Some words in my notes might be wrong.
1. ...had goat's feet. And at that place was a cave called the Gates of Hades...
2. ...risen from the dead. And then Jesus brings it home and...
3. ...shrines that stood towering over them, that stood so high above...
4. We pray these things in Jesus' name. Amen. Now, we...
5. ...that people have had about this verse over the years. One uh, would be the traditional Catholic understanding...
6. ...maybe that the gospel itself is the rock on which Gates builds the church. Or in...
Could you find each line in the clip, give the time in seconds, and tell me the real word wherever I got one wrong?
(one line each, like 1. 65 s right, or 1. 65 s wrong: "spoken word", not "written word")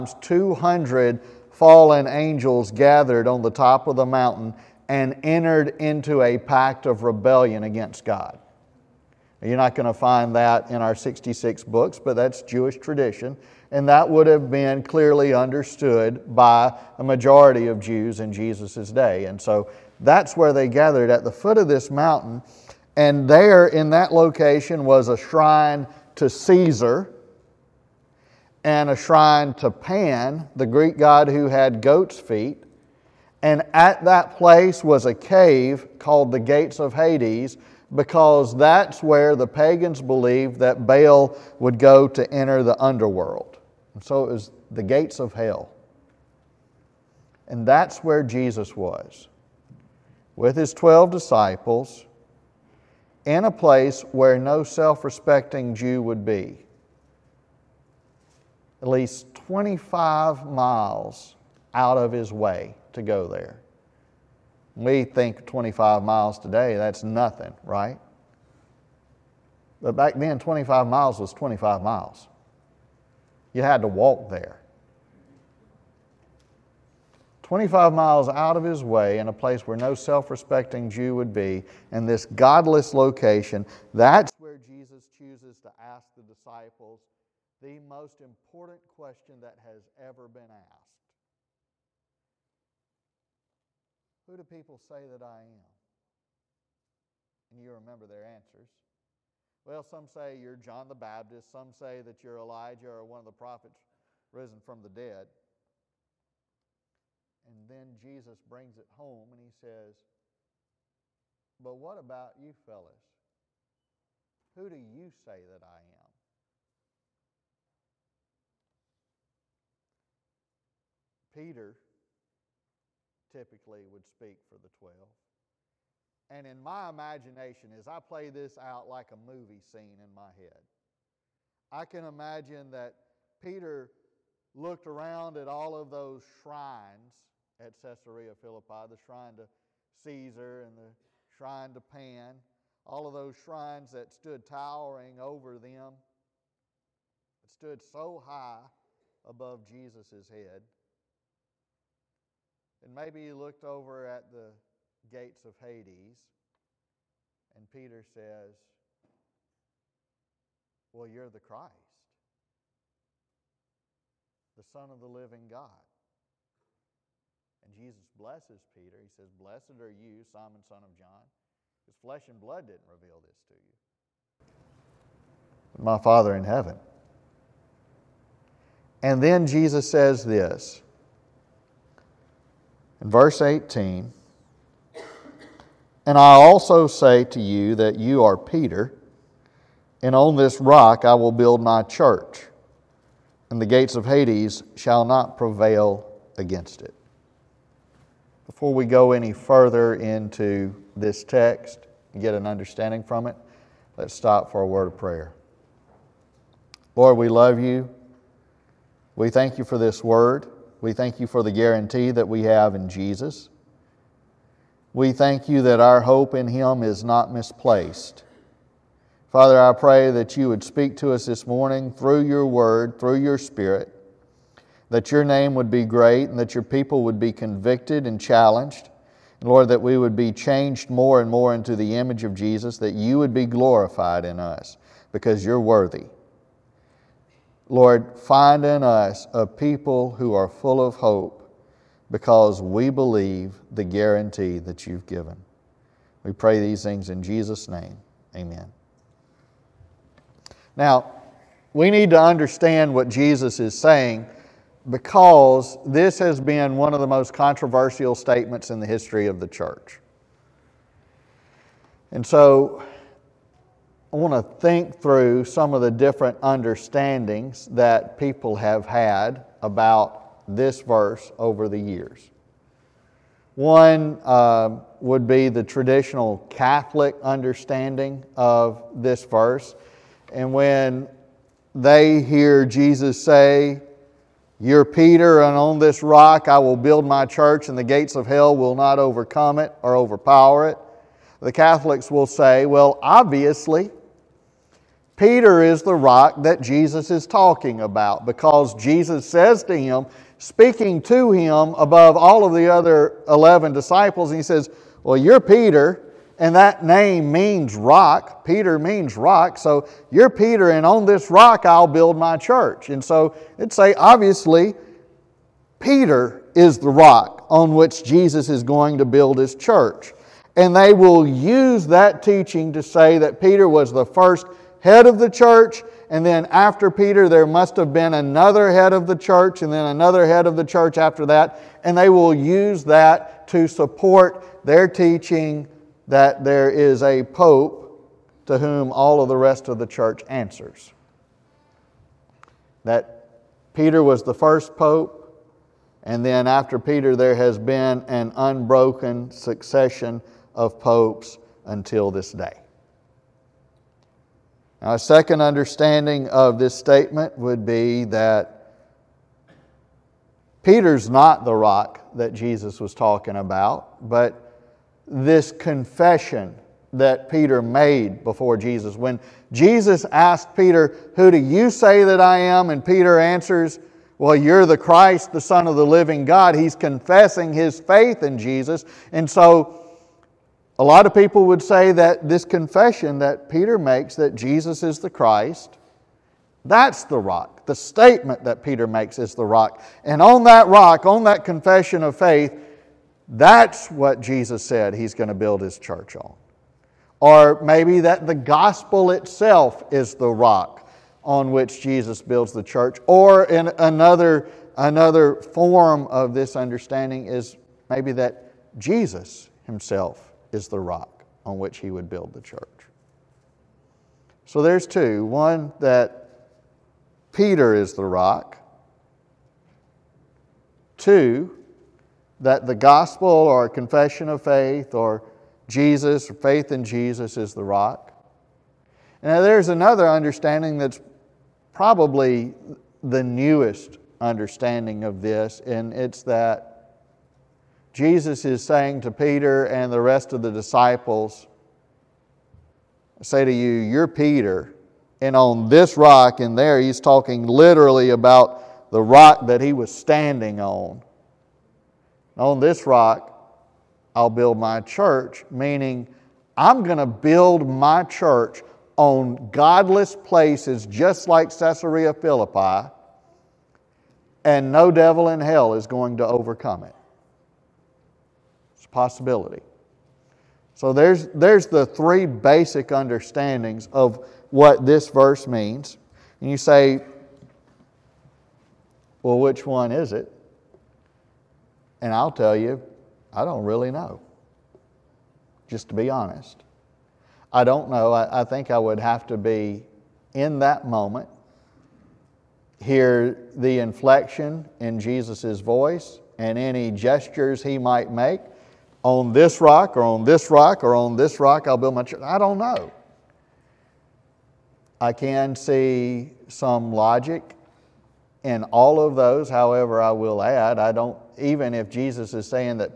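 1. 31 s right
2. 104 s right
3. 143 s right
4. 246 s right
5. 267 s right
6. 397 s wrong: "Jesus", not "Gates".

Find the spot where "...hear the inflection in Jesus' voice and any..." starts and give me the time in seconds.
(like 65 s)
492 s.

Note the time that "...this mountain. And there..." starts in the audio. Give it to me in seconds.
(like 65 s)
21 s.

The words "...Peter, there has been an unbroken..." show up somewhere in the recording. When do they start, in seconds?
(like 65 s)
346 s.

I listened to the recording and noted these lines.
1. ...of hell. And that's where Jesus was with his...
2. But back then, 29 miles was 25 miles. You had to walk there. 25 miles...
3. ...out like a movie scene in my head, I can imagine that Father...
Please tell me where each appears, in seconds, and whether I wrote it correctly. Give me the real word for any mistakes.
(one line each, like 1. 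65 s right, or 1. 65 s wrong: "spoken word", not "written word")
1. 45 s right
2. 69 s wrong: "25", not "29"
3. 128 s wrong: "Peter", not "Father".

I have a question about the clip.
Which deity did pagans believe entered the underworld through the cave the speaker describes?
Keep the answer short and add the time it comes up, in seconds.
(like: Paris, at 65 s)
Baal, at 40 s.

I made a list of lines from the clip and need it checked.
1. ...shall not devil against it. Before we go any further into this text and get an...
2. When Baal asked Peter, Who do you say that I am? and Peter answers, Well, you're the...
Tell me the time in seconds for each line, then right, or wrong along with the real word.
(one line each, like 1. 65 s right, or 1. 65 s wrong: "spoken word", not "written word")
1. 194 s wrong: "prevail", not "devil"
2. 368 s wrong: "Jesus", not "Baal".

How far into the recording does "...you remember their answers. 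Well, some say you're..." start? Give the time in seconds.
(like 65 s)
97 s.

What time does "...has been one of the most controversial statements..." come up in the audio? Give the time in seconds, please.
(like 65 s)
256 s.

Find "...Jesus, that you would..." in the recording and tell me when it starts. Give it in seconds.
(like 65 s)
232 s.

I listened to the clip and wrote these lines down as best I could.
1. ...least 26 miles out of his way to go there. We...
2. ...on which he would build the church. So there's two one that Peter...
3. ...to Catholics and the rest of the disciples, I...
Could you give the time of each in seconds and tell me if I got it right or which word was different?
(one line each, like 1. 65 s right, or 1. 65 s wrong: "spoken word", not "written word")
1. 58 s wrong: "25", not "26"
2. 411 s right
3. 439 s wrong: "Peter", not "Catholics".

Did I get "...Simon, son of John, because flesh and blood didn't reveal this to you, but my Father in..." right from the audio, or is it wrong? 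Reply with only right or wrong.
right.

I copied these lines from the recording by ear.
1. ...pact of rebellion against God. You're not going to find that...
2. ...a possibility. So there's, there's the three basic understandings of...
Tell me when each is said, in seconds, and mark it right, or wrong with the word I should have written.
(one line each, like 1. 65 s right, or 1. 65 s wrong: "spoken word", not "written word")
1. 6 s right
2. 468 s right.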